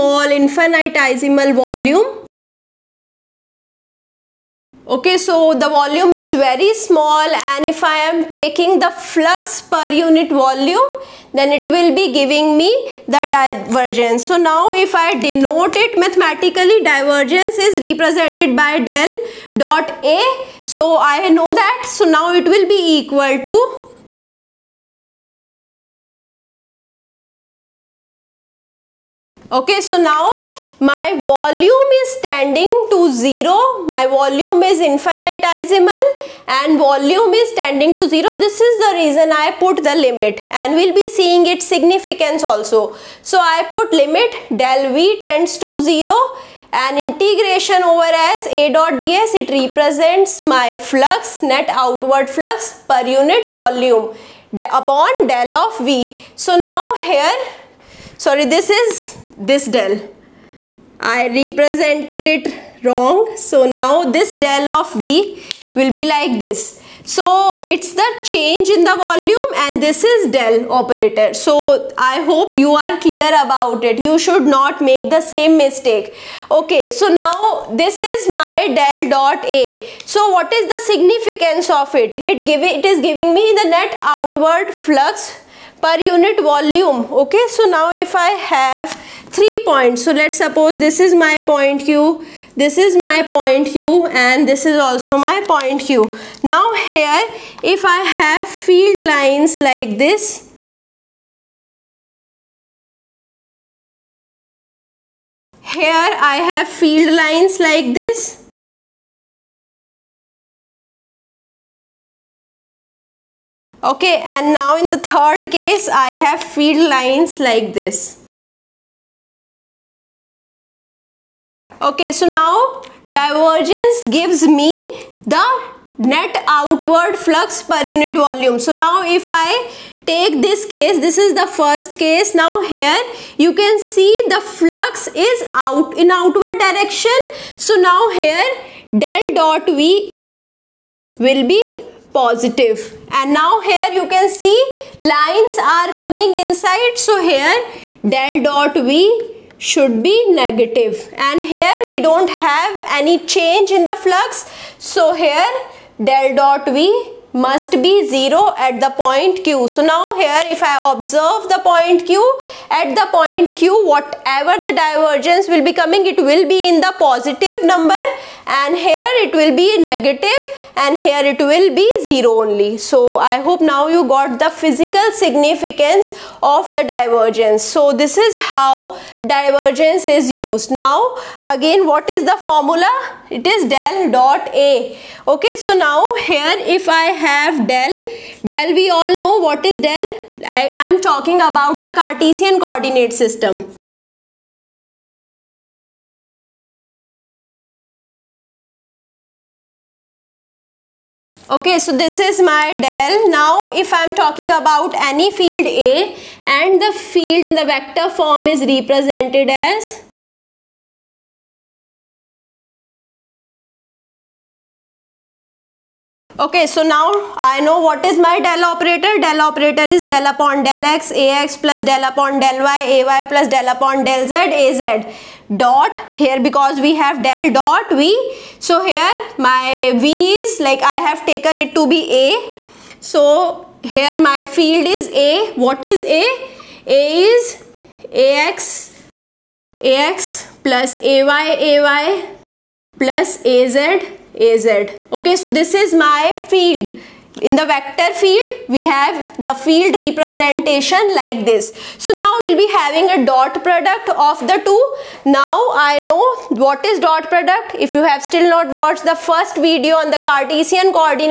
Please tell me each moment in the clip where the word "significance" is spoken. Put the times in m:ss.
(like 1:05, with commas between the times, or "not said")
0:41, 1:20, 2:55.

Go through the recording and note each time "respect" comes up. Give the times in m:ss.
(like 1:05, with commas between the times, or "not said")
not said.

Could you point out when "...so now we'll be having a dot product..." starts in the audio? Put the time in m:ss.
4:11.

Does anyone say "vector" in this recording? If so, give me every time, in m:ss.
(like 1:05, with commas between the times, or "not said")
3:27, 4:07.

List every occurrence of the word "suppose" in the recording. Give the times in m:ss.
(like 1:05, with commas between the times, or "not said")
1:30.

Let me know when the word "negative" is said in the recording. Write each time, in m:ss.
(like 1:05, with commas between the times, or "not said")
2:30, 2:49.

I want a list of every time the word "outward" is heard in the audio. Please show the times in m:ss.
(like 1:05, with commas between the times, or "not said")
0:51, 1:23, 2:06, 2:16.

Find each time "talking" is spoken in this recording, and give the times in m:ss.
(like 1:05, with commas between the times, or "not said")
3:10, 3:24.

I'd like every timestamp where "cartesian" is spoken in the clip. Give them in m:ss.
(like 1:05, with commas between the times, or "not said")
3:11, 4:20.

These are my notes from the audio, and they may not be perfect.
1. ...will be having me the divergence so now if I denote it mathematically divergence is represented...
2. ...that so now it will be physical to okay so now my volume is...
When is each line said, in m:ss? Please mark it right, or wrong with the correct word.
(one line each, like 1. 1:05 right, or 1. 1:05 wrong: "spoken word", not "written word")
1. 0:11 wrong: "giving", not "having"
2. 0:21 wrong: "equal", not "physical".